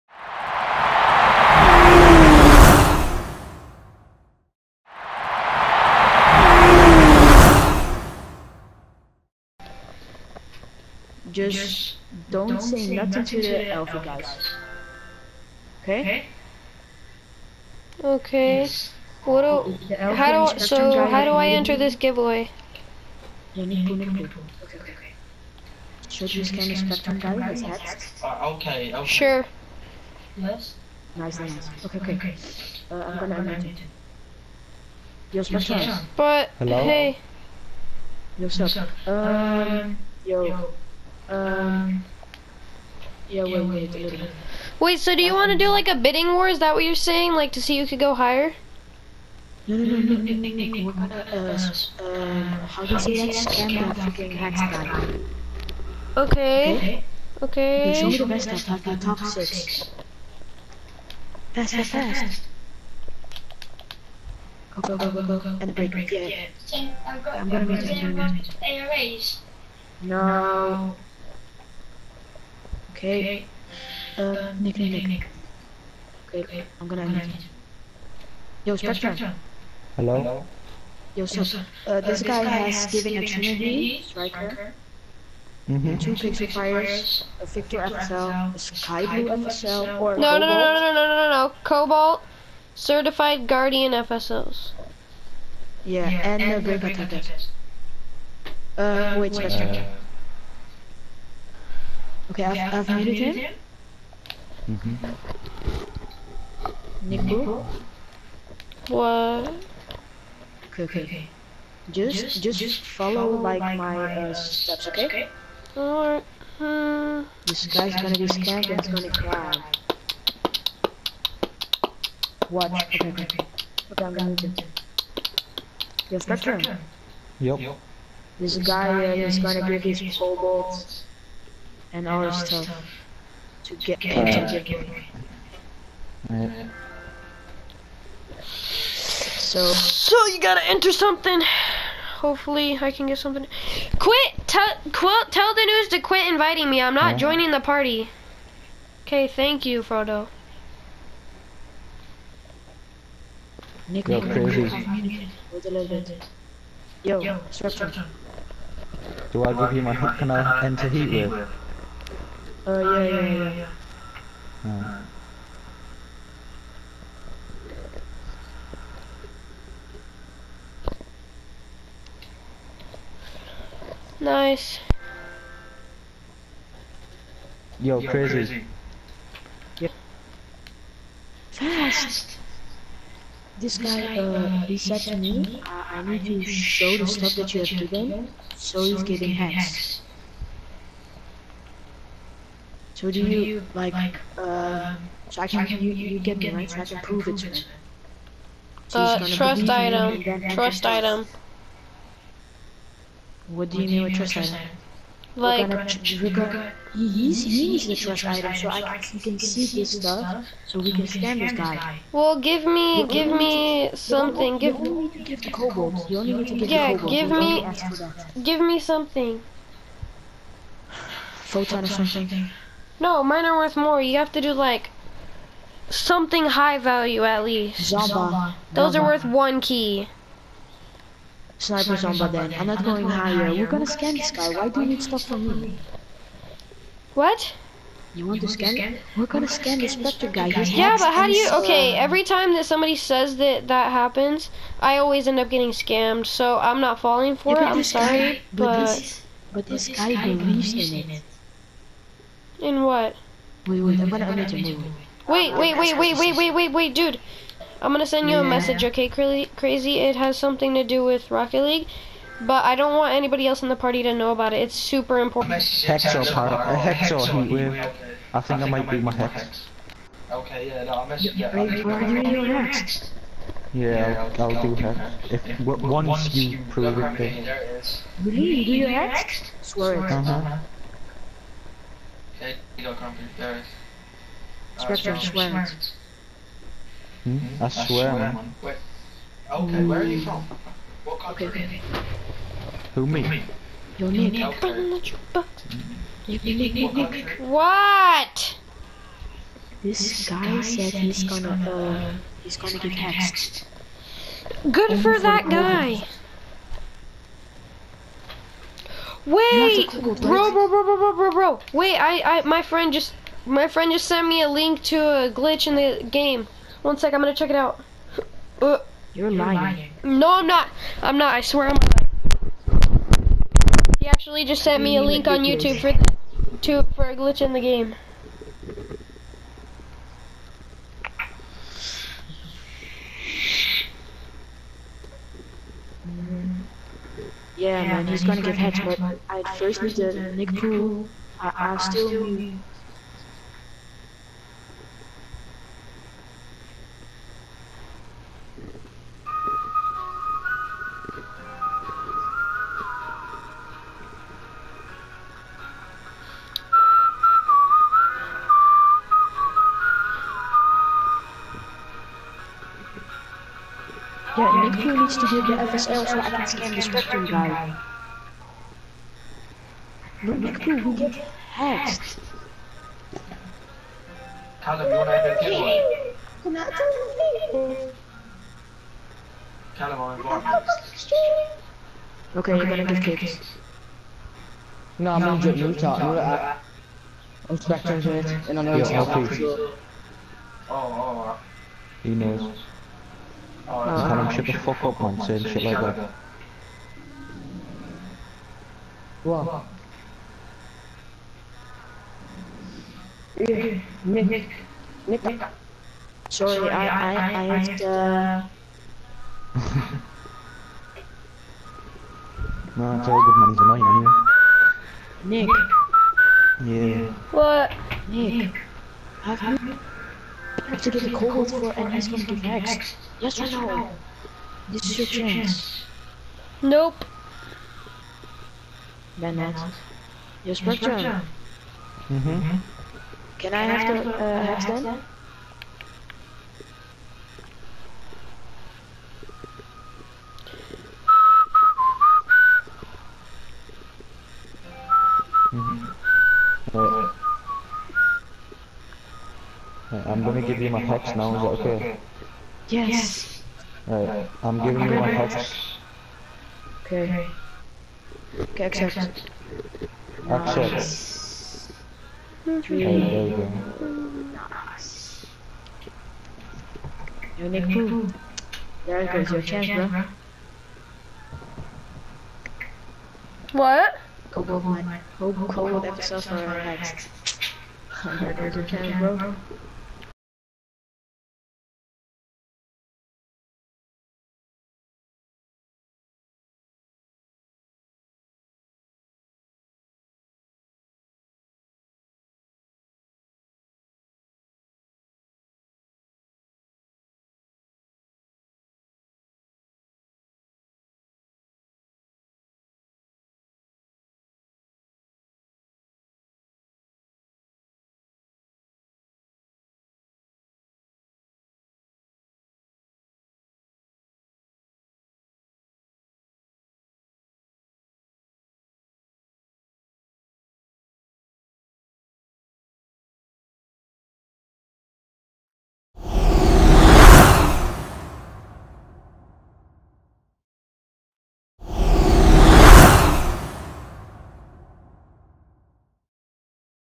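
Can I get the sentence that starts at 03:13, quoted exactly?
So do, so you, do you, like, like uh, um, so I can, you, you, get, me, right?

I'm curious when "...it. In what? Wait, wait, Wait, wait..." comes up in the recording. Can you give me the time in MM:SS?
04:11.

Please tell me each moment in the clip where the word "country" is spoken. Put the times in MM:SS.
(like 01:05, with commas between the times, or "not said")
04:51.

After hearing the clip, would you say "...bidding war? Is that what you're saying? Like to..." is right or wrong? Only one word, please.
right.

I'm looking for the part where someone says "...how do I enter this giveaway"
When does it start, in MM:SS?
00:21.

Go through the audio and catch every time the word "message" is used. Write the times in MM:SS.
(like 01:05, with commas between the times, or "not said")
04:18, 04:31.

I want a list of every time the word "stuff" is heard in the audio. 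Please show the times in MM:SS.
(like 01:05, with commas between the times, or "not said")
00:58, 02:12, 03:07, 03:29, 03:55.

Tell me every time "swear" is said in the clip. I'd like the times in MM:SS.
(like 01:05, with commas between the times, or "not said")
04:39, 04:47, 05:21.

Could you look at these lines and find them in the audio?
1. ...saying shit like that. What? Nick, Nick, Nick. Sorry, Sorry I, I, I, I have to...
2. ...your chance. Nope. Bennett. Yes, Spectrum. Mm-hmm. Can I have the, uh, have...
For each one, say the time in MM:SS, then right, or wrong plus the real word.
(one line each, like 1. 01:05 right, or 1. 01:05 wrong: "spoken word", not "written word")
1. 06:35 right
2. 07:04 right.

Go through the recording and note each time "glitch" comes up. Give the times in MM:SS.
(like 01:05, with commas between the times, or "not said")
05:15, 05:27.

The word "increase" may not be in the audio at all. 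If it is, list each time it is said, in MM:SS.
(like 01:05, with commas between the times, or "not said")
not said.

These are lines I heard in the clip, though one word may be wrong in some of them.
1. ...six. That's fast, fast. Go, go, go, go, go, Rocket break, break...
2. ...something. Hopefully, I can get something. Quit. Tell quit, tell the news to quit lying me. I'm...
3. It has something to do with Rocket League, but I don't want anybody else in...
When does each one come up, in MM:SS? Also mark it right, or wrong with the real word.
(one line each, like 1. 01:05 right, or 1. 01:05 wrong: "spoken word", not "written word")
1. 00:59 wrong: "And", not "Rocket"
2. 02:20 wrong: "inviting", not "lying"
3. 04:19 right.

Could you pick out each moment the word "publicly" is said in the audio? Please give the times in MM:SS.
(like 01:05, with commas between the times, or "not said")
not said.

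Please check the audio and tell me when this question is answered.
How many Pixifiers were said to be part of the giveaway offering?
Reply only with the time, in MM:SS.
01:25.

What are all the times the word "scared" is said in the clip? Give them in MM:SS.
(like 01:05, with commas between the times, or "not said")
01:58.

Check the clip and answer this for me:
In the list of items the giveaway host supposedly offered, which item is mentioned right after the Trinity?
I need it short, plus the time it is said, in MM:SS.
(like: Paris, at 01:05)
Striker, at 01:24.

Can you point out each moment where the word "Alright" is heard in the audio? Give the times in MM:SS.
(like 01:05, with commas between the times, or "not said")
01:55, 07:33.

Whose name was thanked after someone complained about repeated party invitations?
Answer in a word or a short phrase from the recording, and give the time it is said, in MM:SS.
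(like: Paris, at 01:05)
Frodo, at 02:29.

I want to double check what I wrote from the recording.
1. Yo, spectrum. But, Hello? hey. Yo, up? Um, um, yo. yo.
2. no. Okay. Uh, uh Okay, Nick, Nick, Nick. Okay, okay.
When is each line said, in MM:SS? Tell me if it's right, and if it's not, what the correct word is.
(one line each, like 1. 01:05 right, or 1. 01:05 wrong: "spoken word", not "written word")
1. 00:35 right
2. 01:10 wrong: "Nick", not "Okay".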